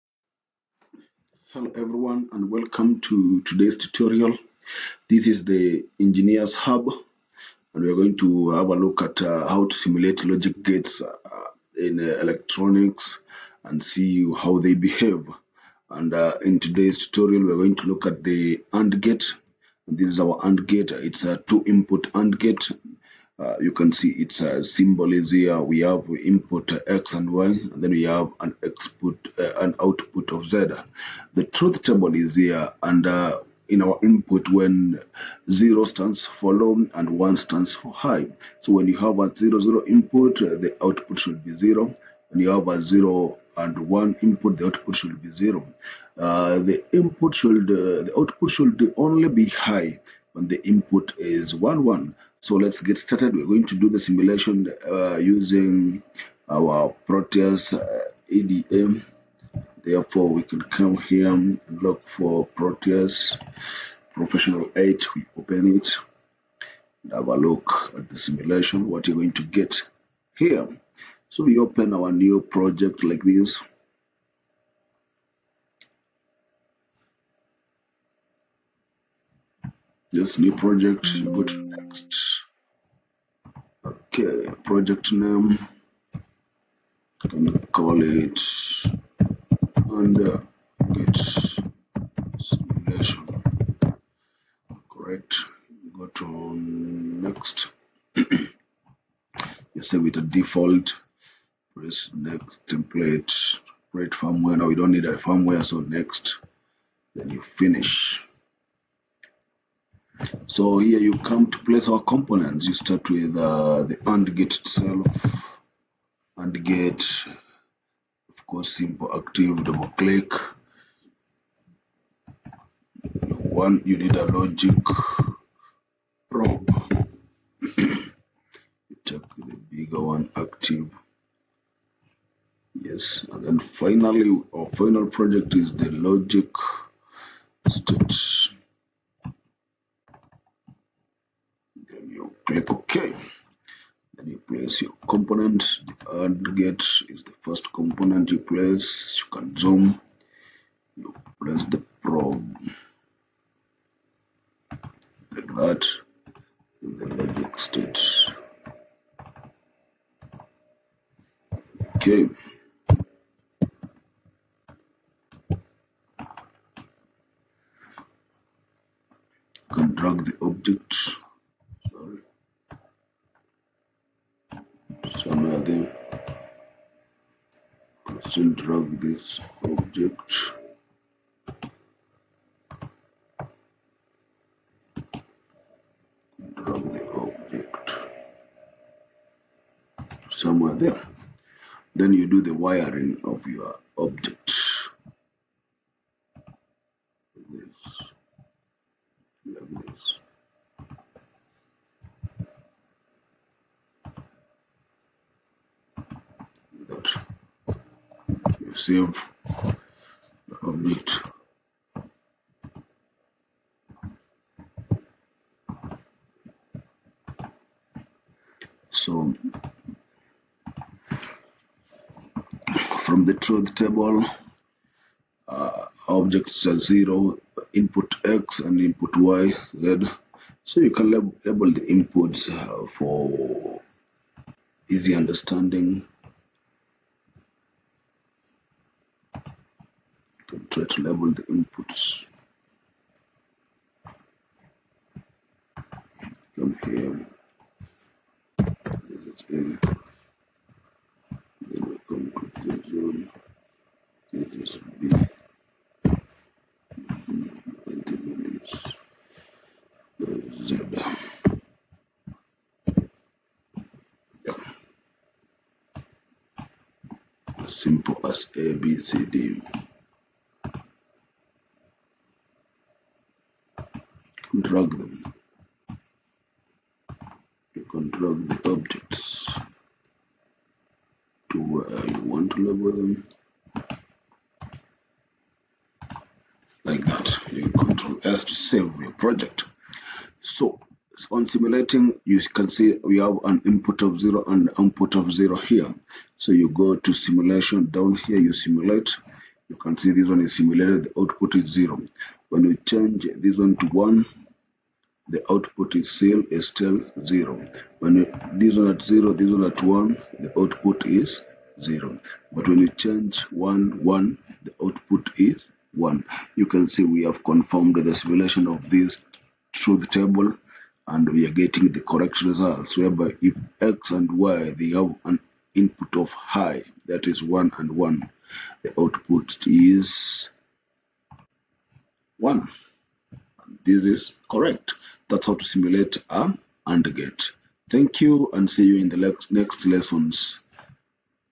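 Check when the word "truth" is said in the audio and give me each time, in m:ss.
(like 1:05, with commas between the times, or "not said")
0:31, 3:43, 5:19.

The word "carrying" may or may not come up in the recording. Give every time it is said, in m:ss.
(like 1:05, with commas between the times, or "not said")
not said.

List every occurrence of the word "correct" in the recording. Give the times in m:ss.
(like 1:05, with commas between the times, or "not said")
1:34, 5:22, 5:34.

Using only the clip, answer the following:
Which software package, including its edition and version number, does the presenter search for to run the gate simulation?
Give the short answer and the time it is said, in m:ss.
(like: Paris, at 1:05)
Proteus Professional 8, at 1:02.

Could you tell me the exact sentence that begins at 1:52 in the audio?
You start with uh, the AND gate itself.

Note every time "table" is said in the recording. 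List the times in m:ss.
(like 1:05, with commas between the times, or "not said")
0:31, 3:43, 5:20.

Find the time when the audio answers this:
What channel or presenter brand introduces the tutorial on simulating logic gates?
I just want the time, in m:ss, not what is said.
0:05.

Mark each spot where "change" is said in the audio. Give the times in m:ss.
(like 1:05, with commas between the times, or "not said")
5:02, 5:12.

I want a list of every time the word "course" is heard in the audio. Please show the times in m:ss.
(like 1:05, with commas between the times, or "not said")
1:58.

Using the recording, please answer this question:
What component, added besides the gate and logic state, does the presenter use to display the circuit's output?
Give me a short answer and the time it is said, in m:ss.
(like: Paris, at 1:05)
A logic probe, at 2:04.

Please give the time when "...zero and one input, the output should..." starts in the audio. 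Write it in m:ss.
0:42.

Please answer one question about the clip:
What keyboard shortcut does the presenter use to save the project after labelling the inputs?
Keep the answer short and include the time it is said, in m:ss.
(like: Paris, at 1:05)
Control S, at 4:47.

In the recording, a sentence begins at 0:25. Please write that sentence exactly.
We have input X and Y, and then we have an output, uh, an output of Z.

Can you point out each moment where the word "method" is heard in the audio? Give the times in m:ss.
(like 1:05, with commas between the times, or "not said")
not said.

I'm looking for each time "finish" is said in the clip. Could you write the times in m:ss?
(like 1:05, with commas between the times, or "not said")
1:47.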